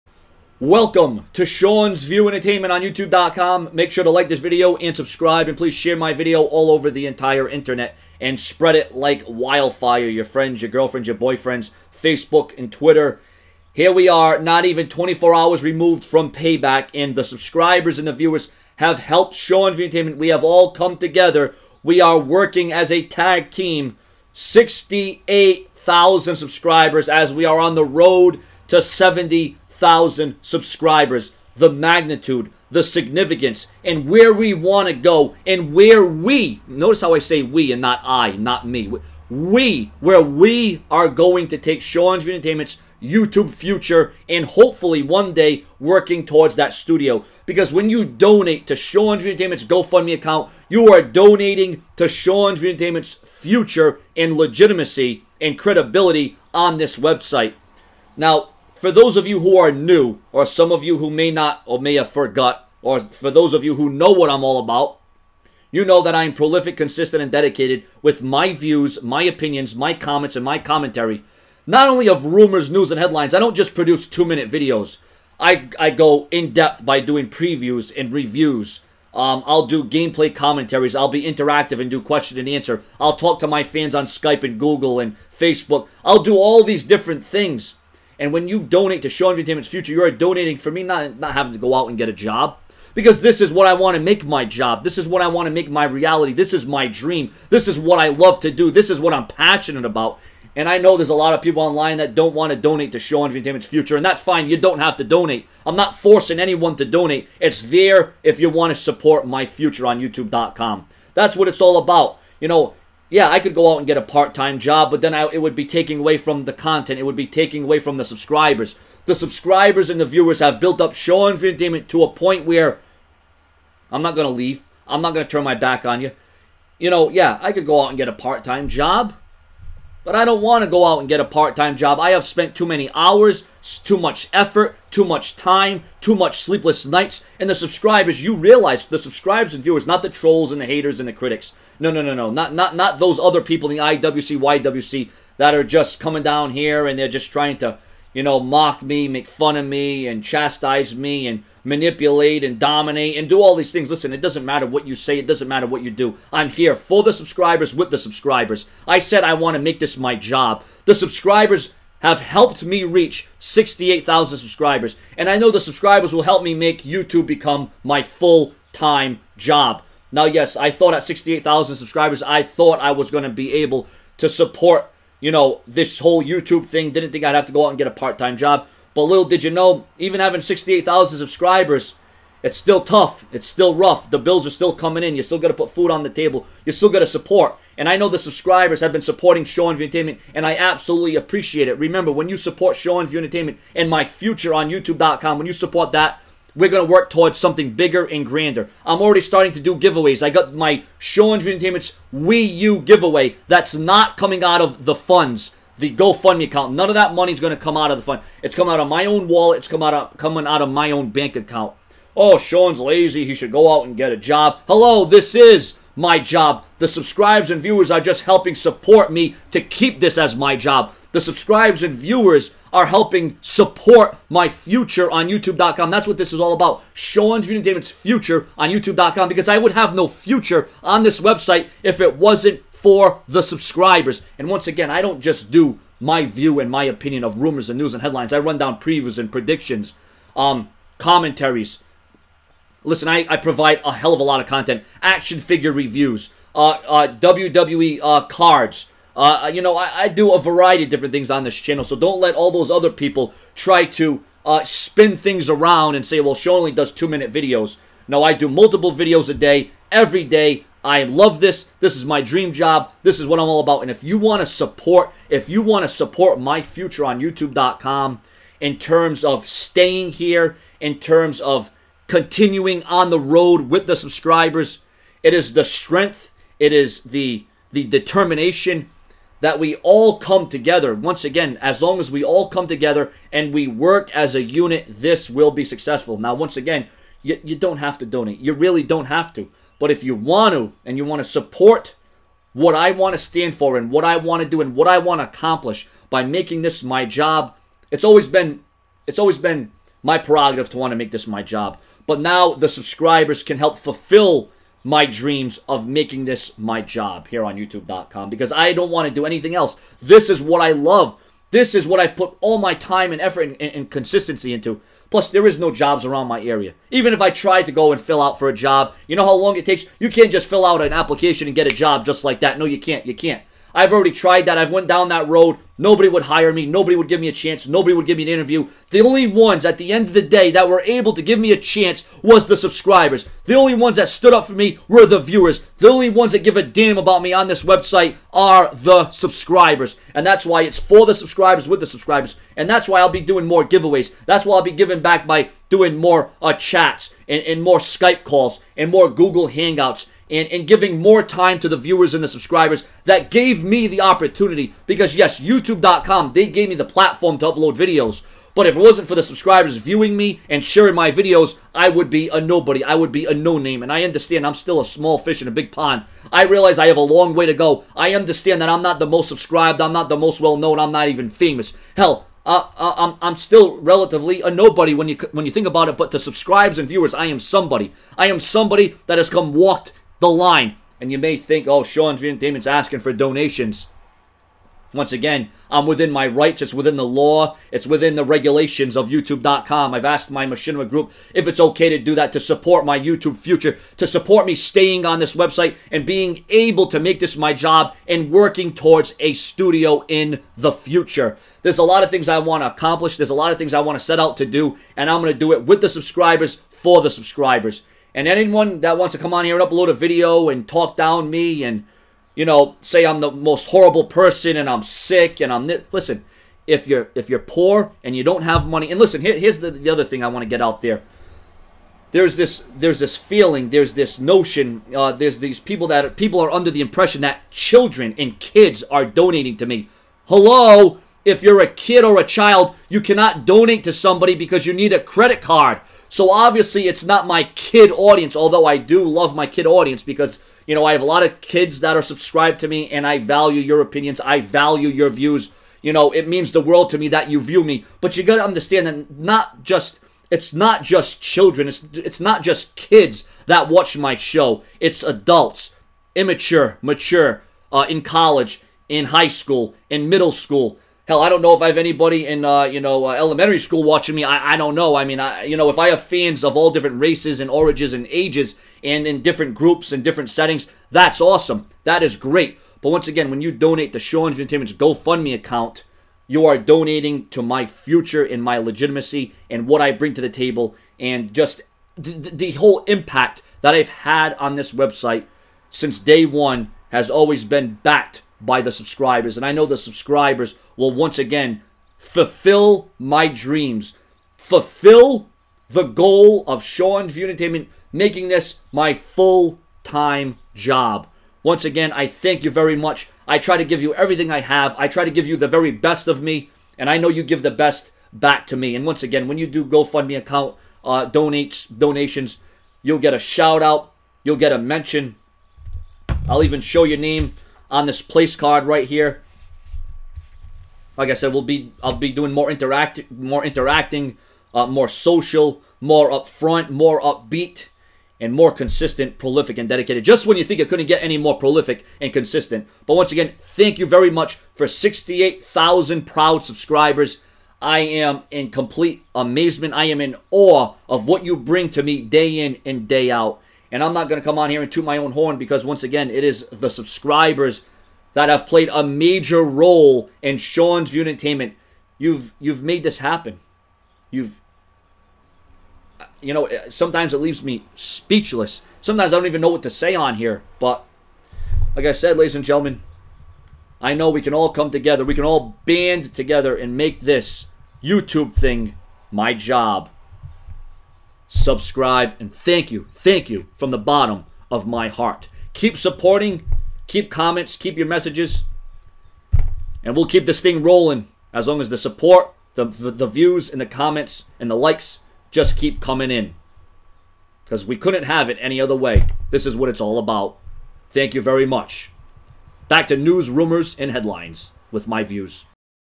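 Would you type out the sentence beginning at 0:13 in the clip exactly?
Here we are, not even 24 hours removed from payback, and the subscribers and the viewers have helped Sean's View Entertainment.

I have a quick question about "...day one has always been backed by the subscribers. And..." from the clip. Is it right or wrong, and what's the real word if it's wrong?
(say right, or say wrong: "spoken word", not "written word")
right.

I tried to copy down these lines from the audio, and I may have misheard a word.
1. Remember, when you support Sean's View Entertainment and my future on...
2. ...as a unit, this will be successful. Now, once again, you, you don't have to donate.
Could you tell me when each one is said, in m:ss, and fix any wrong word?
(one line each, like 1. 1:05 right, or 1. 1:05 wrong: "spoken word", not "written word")
1. 3:11 right
2. 4:44 right.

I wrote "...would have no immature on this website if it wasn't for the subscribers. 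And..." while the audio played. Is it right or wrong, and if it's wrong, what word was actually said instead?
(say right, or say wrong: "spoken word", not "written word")
wrong: "future", not "immature".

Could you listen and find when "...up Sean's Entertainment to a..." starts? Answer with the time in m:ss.
2:00.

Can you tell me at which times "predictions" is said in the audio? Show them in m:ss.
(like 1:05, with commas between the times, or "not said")
3:59.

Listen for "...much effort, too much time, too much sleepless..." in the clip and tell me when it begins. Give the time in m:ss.
2:13.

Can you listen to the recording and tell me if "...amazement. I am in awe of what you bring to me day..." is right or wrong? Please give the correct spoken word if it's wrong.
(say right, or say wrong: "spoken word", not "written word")
right.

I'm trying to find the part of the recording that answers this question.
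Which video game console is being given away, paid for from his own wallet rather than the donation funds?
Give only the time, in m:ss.
3:22.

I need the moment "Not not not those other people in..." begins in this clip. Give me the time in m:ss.
2:22.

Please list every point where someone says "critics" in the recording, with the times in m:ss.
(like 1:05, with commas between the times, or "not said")
2:21.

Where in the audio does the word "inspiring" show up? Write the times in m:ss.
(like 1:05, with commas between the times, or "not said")
not said.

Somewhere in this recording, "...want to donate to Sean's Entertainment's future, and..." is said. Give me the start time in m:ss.
1:42.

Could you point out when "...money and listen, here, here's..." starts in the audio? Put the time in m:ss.
6:58.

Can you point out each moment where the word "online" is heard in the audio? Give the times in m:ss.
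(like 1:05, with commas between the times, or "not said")
1:41.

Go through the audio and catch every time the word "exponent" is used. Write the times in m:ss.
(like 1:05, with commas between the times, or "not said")
not said.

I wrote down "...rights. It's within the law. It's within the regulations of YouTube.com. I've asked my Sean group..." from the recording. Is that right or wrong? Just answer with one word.
wrong.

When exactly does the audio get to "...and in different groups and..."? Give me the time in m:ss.
7:48.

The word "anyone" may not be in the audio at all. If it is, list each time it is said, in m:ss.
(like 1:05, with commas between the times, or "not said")
1:46, 6:48.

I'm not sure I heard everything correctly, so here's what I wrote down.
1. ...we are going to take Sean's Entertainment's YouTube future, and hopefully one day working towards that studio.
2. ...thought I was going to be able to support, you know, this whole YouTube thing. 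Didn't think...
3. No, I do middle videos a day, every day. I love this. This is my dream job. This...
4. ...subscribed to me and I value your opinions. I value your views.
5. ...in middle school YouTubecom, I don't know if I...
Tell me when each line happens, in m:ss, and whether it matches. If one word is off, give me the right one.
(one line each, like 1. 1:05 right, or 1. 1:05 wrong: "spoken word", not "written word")
1. 0:40 right
2. 2:52 right
3. 4:18 wrong: "multiple", not "middle"
4. 7:22 right
5. 7:39 wrong: "Hell", not "YouTubecom".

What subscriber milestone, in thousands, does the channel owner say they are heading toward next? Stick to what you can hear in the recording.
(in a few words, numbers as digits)
70.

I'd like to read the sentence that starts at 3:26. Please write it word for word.
None of that money is going to come out of the fund.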